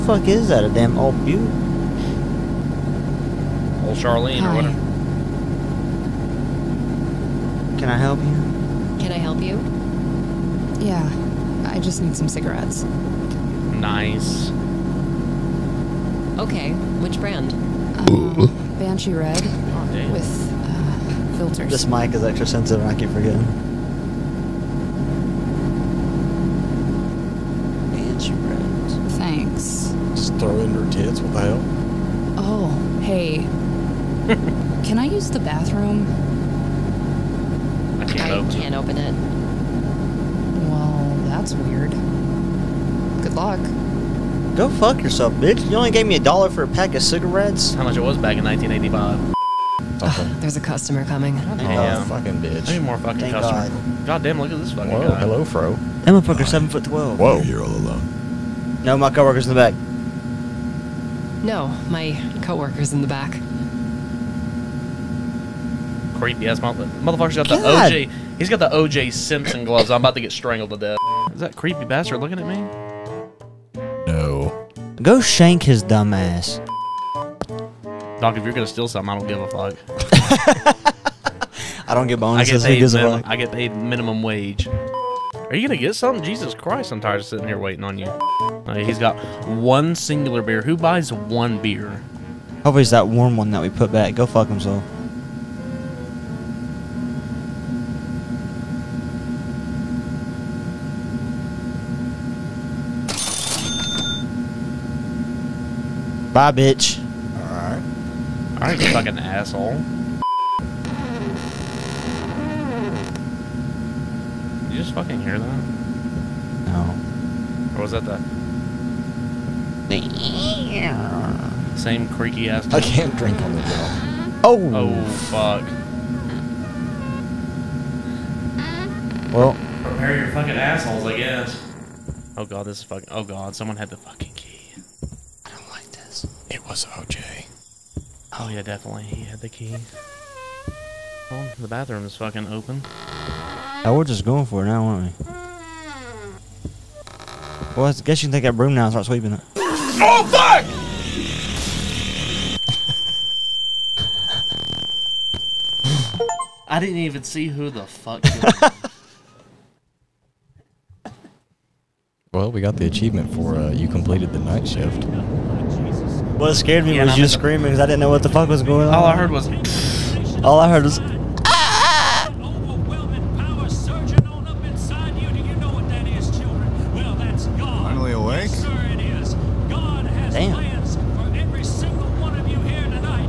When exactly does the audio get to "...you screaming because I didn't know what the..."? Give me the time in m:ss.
2:47.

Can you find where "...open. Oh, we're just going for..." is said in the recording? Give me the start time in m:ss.
2:22.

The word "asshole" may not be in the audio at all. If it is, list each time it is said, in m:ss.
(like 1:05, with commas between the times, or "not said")
1:49, 2:10.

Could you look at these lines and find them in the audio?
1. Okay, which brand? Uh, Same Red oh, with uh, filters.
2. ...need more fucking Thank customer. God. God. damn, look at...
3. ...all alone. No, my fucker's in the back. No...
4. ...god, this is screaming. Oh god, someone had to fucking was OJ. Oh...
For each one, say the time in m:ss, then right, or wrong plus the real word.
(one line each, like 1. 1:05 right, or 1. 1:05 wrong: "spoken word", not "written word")
1. 0:16 wrong: "Banshee", not "Same"
2. 0:52 right
3. 0:57 wrong: "coworker", not "fucker"
4. 2:12 wrong: "fucking", not "screaming".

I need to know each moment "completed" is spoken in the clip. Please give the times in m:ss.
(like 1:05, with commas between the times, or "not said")
2:43.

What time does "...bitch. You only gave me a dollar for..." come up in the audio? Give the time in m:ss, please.
0:45.